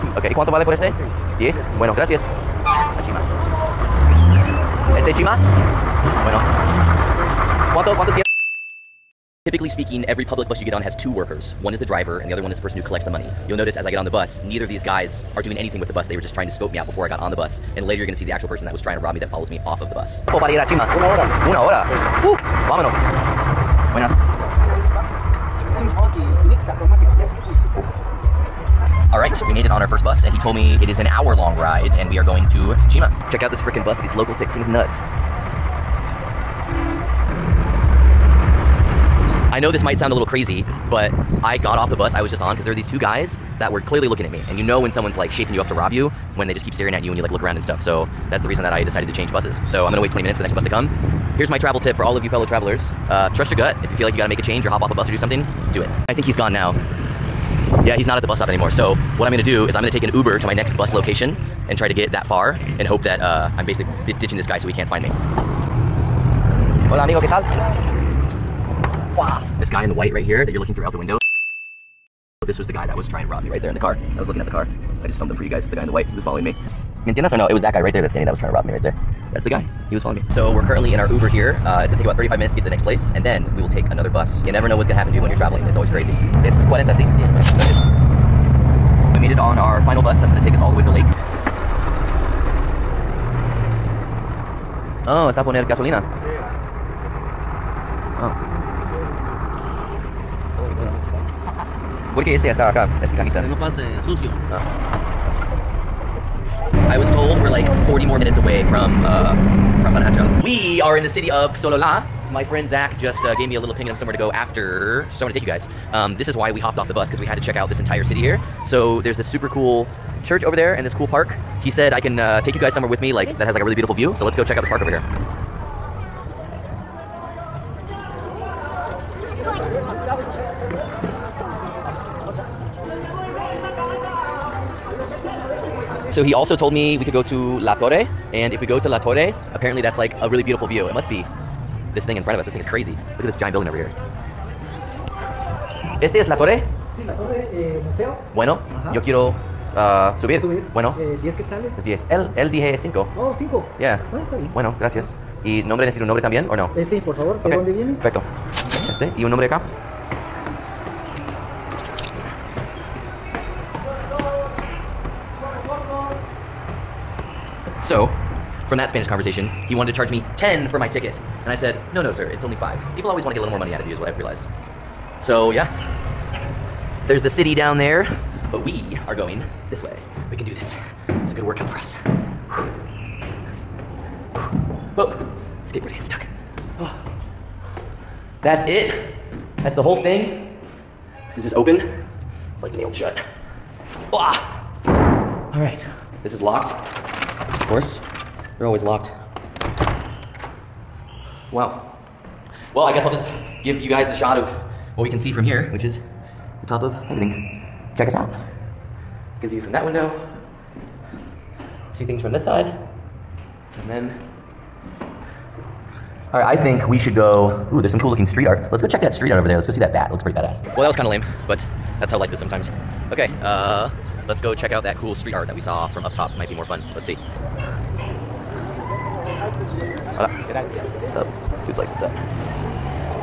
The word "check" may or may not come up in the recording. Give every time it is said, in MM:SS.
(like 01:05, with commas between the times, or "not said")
00:33, 01:57, 02:04, 03:27, 03:38, 03:44.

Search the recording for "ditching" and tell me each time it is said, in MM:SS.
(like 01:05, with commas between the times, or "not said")
01:04.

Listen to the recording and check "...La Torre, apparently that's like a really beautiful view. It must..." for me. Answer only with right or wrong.
right.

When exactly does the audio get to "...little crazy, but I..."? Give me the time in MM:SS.
00:40.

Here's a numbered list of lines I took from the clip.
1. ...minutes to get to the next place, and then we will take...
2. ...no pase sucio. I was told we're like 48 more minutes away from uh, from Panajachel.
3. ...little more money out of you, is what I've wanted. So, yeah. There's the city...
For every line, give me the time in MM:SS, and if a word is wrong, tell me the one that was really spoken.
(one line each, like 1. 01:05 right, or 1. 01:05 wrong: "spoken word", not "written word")
1. 01:22 right
2. 01:43 wrong: "40", not "48"
3. 02:53 wrong: "realized", not "wanted".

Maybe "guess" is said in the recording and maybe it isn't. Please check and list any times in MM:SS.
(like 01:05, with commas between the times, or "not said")
03:22.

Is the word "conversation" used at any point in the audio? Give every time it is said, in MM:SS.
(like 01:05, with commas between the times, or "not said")
02:49.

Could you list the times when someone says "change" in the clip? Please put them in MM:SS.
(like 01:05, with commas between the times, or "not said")
00:49, 00:54.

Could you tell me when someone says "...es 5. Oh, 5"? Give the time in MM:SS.
02:32.